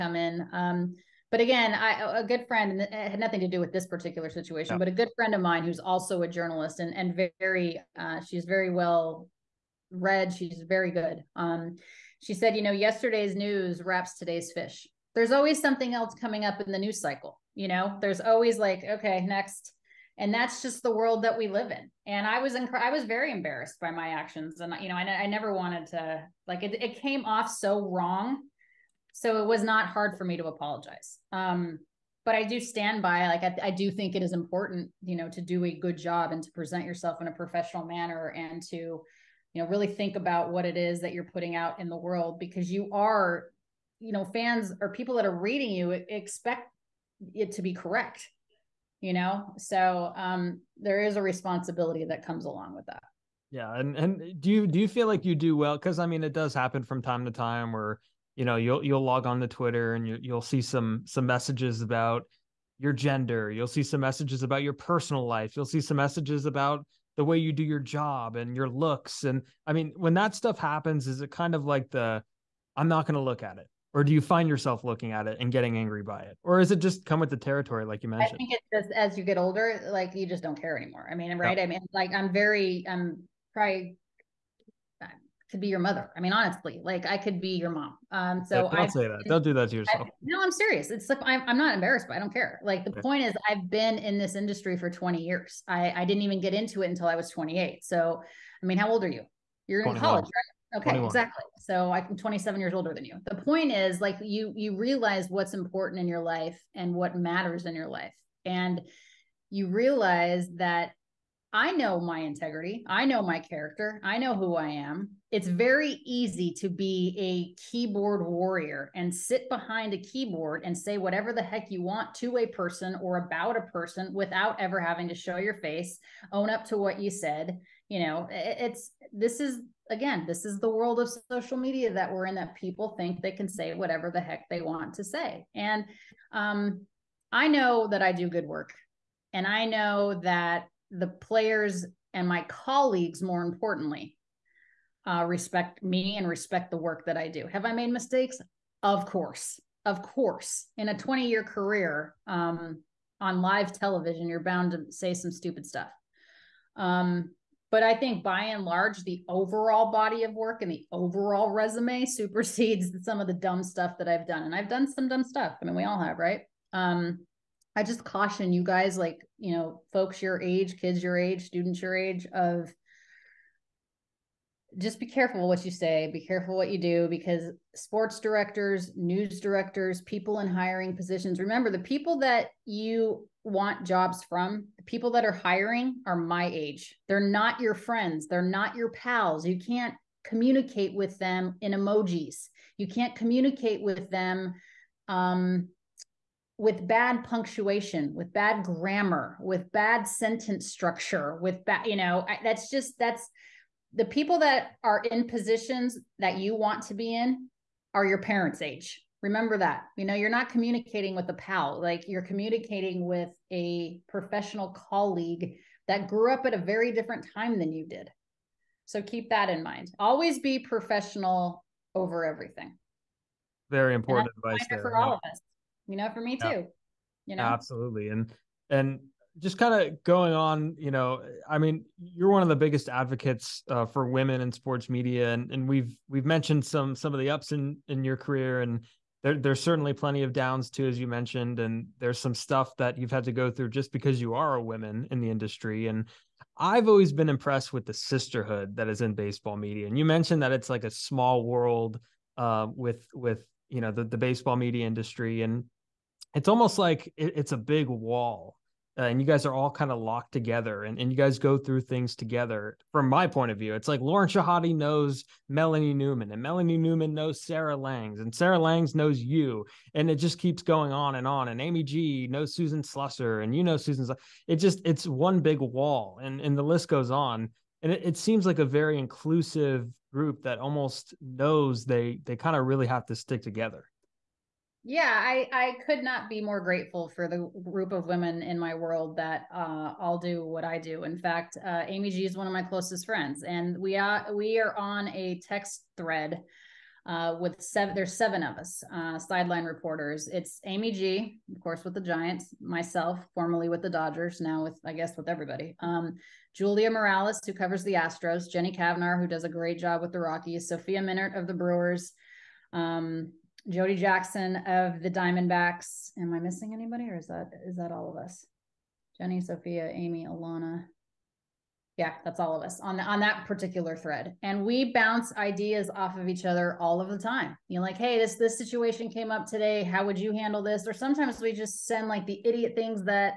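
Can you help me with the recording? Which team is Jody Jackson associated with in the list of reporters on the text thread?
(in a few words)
Diamondbacks.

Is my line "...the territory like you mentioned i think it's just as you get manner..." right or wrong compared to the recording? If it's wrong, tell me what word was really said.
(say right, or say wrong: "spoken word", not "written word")
wrong: "older", not "manner".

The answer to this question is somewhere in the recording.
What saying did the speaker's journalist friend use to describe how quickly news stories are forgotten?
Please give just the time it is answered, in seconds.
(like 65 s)
12 s.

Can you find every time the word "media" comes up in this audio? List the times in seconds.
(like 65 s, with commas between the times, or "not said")
131 s, 234 s, 249 s, 254 s.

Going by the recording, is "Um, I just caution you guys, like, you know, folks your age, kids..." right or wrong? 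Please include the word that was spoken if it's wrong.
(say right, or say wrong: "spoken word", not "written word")
right.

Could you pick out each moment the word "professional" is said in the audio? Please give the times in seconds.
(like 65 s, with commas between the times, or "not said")
37 s, 214 s, 220 s.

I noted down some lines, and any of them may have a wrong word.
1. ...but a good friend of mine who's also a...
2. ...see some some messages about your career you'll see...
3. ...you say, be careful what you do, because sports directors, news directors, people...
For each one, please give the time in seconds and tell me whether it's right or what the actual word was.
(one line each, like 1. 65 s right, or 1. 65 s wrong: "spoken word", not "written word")
1. 4 s right
2. 60 s wrong: "gender", not "career"
3. 175 s right.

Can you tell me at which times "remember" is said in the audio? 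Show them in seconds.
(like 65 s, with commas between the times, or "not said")
181 s, 209 s.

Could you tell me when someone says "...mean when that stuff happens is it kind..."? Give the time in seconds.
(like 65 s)
69 s.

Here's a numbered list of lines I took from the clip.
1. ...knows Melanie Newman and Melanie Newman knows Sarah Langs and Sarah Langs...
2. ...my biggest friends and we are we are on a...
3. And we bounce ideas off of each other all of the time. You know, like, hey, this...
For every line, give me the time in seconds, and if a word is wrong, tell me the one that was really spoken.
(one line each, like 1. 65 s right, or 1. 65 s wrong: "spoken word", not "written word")
1. 264 s right
2. 292 s wrong: "closest", not "biggest"
3. 324 s right.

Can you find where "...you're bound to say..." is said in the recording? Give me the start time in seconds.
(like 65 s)
154 s.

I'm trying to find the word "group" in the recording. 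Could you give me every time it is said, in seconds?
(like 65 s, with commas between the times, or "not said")
280 s, 287 s.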